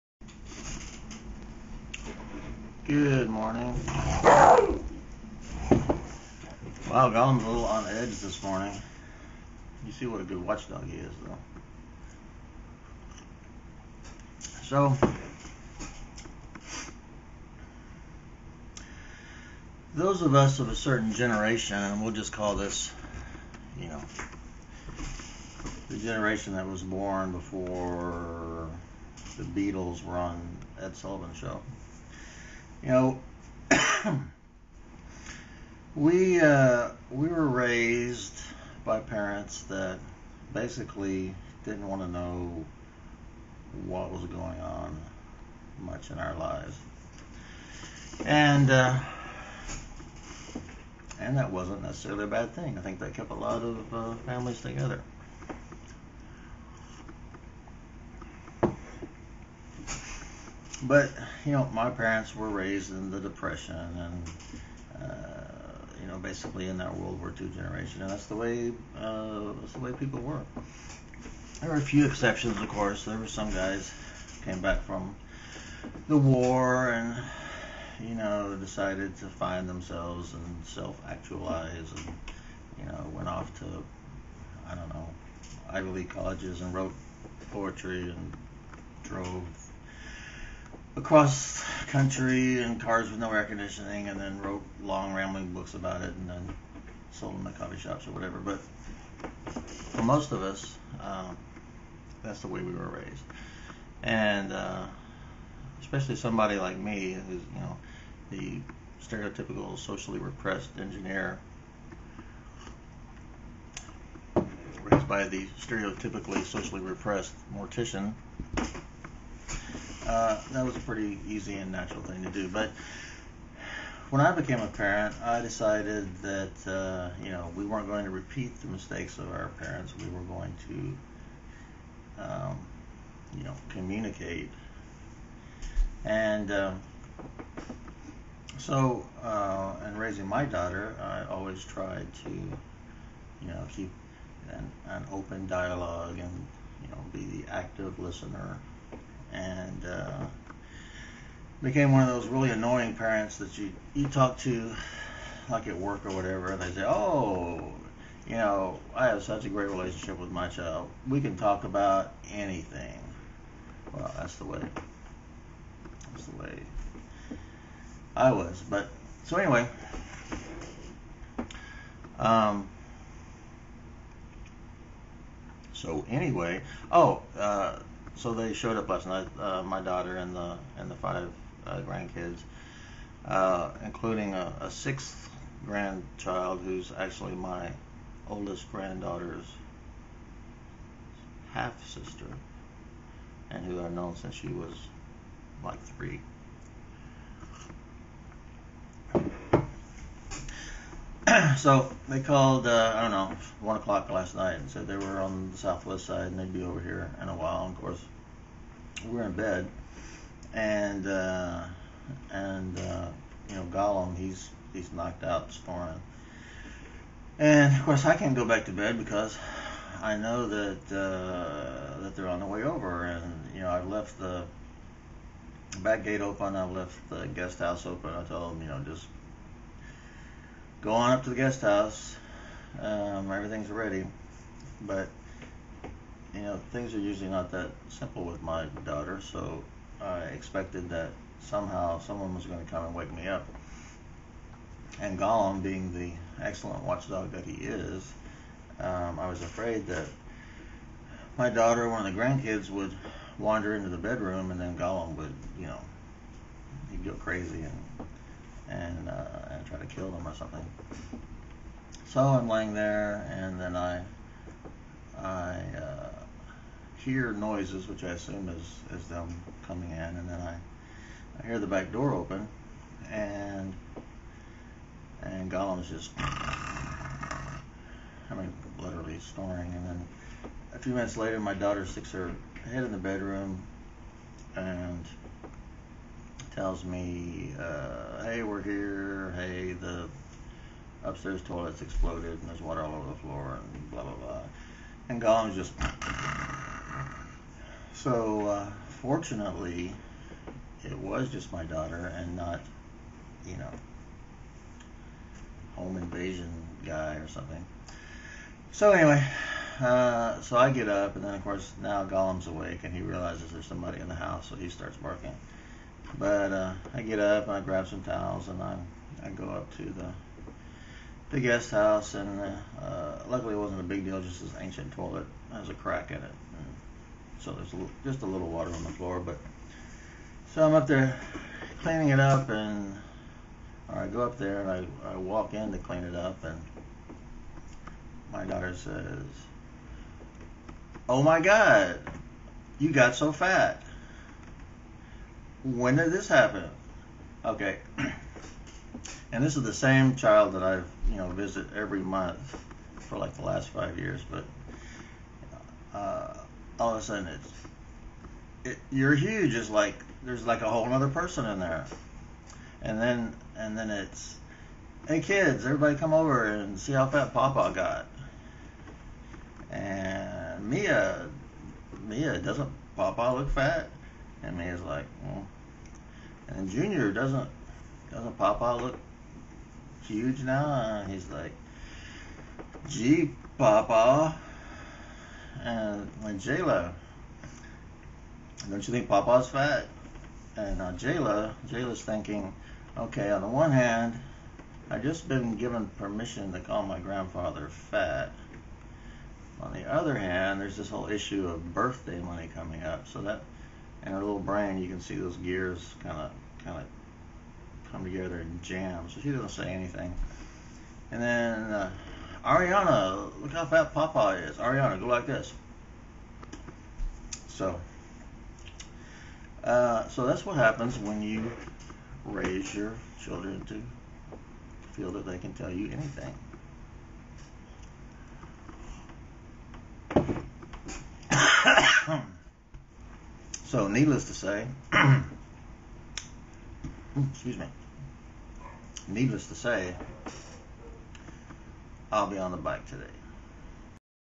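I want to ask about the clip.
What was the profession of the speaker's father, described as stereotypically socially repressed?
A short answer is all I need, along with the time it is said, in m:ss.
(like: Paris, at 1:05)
mortician, at 1:57.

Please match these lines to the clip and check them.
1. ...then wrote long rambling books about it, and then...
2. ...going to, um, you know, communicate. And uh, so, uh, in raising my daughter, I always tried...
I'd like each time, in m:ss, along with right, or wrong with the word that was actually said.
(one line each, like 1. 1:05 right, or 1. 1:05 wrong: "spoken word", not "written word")
1. 1:34 right
2. 2:10 right.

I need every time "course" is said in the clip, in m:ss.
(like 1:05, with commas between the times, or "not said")
1:12, 3:27, 3:37, 5:11.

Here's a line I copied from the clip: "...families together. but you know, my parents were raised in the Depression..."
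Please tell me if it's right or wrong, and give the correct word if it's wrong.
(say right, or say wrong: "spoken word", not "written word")
right.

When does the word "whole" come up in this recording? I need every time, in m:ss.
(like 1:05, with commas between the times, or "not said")
6:00, 6:40.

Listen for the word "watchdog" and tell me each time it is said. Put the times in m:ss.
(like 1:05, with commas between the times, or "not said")
0:10, 4:06.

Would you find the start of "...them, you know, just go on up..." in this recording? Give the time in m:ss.
3:48.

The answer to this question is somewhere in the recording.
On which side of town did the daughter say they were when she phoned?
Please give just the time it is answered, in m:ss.
3:25.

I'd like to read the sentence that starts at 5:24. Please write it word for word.
Just this ancient toilet has a crack in it, and so there's a little, just a little water on the floor.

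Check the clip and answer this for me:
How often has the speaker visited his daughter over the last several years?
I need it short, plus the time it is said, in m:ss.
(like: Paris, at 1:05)
every month, at 5:51.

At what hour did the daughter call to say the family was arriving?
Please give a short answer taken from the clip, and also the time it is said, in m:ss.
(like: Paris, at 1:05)
1 o'clock, at 3:23.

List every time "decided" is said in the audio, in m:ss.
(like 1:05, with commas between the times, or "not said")
1:18, 2:05.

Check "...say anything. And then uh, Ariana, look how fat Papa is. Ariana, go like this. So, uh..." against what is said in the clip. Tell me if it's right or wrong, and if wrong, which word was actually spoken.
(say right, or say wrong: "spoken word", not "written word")
right.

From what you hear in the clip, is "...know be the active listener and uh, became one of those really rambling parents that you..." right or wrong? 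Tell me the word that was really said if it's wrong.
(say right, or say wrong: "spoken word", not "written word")
wrong: "annoying", not "rambling".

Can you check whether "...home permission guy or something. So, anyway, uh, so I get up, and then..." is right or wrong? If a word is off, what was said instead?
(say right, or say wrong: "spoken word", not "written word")
wrong: "invasion", not "permission".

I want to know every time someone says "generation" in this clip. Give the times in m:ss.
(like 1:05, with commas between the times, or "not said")
0:21, 0:25, 1:07.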